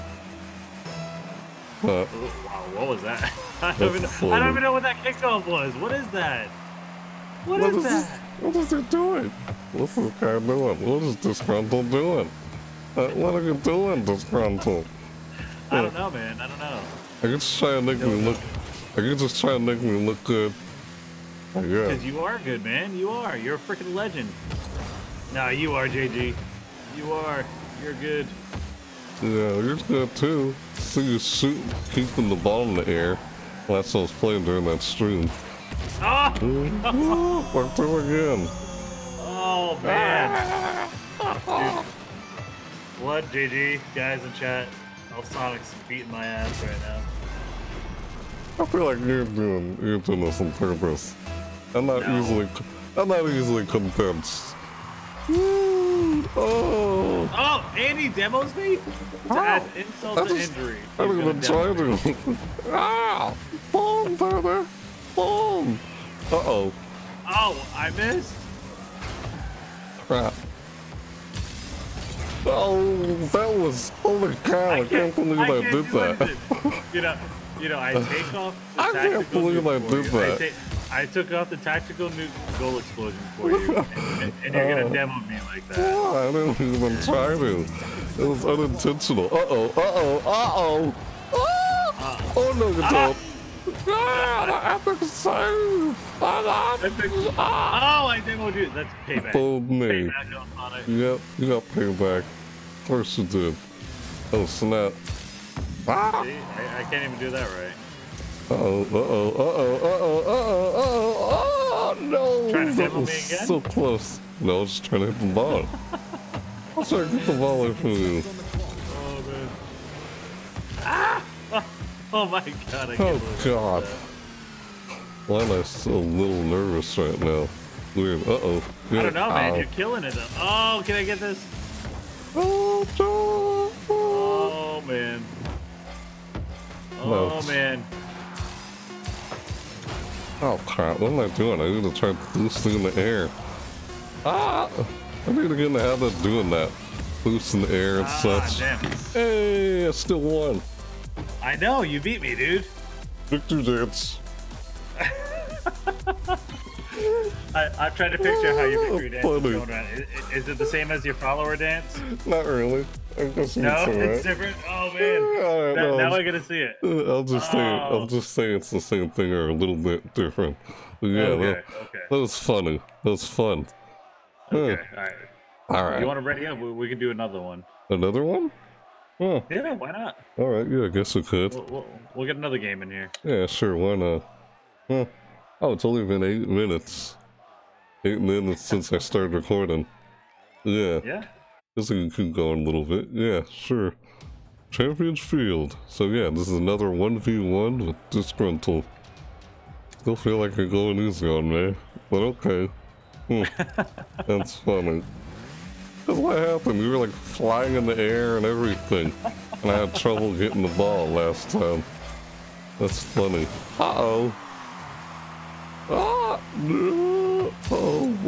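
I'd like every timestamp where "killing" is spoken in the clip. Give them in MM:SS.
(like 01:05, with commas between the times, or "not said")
02:09.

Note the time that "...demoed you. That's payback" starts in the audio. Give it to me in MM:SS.
01:38.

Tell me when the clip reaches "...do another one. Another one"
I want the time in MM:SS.
02:56.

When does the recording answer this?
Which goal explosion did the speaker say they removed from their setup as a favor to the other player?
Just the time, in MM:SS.
01:21.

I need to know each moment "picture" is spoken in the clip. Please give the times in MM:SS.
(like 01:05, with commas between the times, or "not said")
02:38.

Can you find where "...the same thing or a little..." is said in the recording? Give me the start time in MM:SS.
02:48.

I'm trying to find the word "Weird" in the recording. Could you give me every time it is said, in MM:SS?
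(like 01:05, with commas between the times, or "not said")
02:07.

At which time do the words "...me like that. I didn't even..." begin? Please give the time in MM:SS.
01:25.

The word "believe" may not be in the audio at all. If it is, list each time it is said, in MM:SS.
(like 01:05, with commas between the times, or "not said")
01:15, 01:19.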